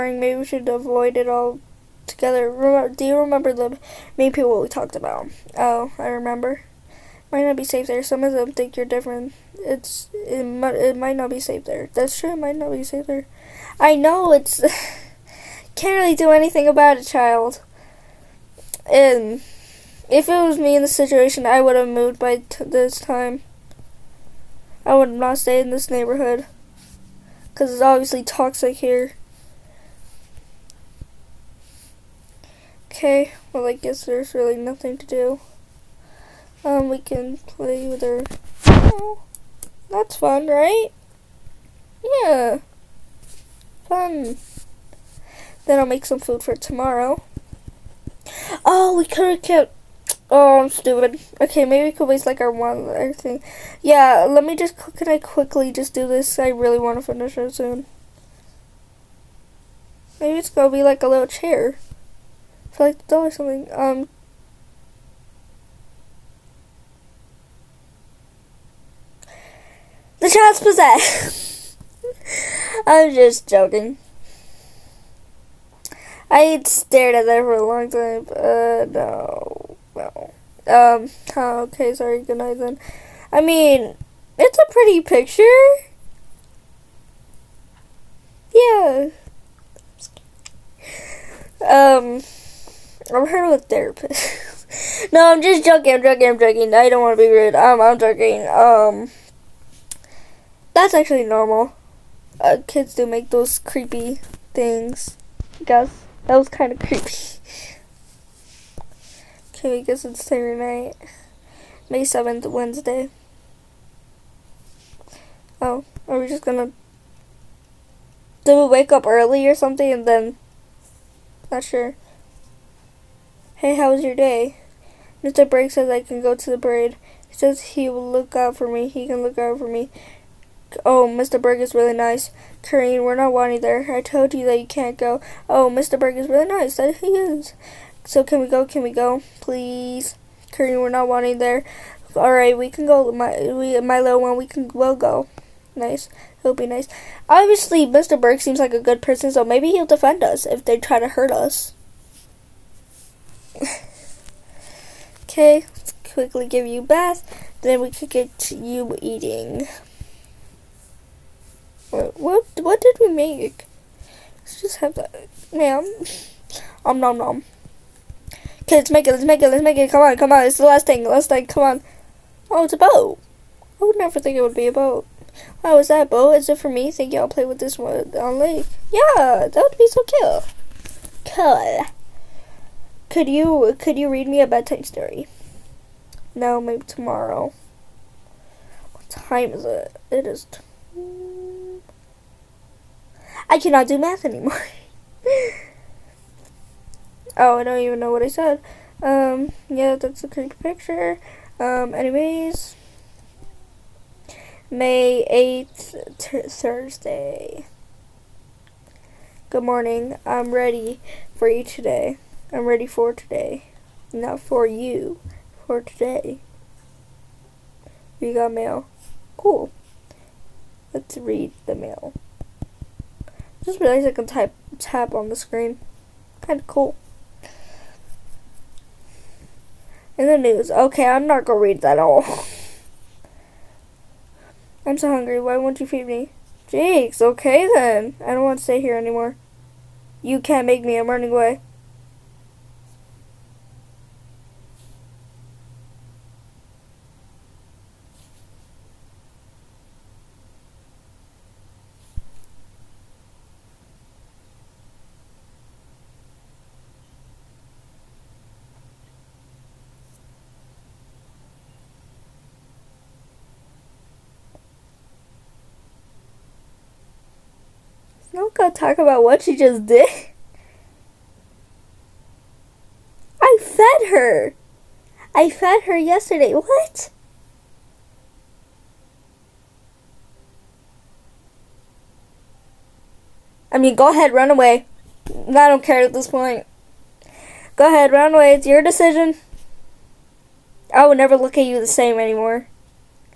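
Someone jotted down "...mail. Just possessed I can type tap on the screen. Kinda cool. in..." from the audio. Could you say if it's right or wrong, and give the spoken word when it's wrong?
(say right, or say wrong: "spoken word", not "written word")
wrong: "realized", not "possessed".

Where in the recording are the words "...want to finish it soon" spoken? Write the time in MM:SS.
00:56.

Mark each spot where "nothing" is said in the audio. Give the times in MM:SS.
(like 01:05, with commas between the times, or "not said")
00:34.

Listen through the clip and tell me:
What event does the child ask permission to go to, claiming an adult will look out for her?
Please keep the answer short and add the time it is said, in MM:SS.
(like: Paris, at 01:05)
parade, at 02:06.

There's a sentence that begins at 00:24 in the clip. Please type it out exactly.
I would not stay in this neighborhood because it's obviously toxic here.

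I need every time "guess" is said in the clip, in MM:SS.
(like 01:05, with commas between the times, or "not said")
00:33, 01:45, 01:49.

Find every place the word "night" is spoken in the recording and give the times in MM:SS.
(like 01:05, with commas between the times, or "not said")
01:22, 01:50.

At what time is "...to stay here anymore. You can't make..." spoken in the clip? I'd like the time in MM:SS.
03:58.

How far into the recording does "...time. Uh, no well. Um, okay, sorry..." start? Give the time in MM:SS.
01:17.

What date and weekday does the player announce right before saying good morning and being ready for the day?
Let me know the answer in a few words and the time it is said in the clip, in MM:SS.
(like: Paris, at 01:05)
May 8, Thursday, at 03:24.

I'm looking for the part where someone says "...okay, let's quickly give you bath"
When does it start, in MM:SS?
02:35.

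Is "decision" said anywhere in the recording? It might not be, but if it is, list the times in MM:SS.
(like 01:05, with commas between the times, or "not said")
04:48.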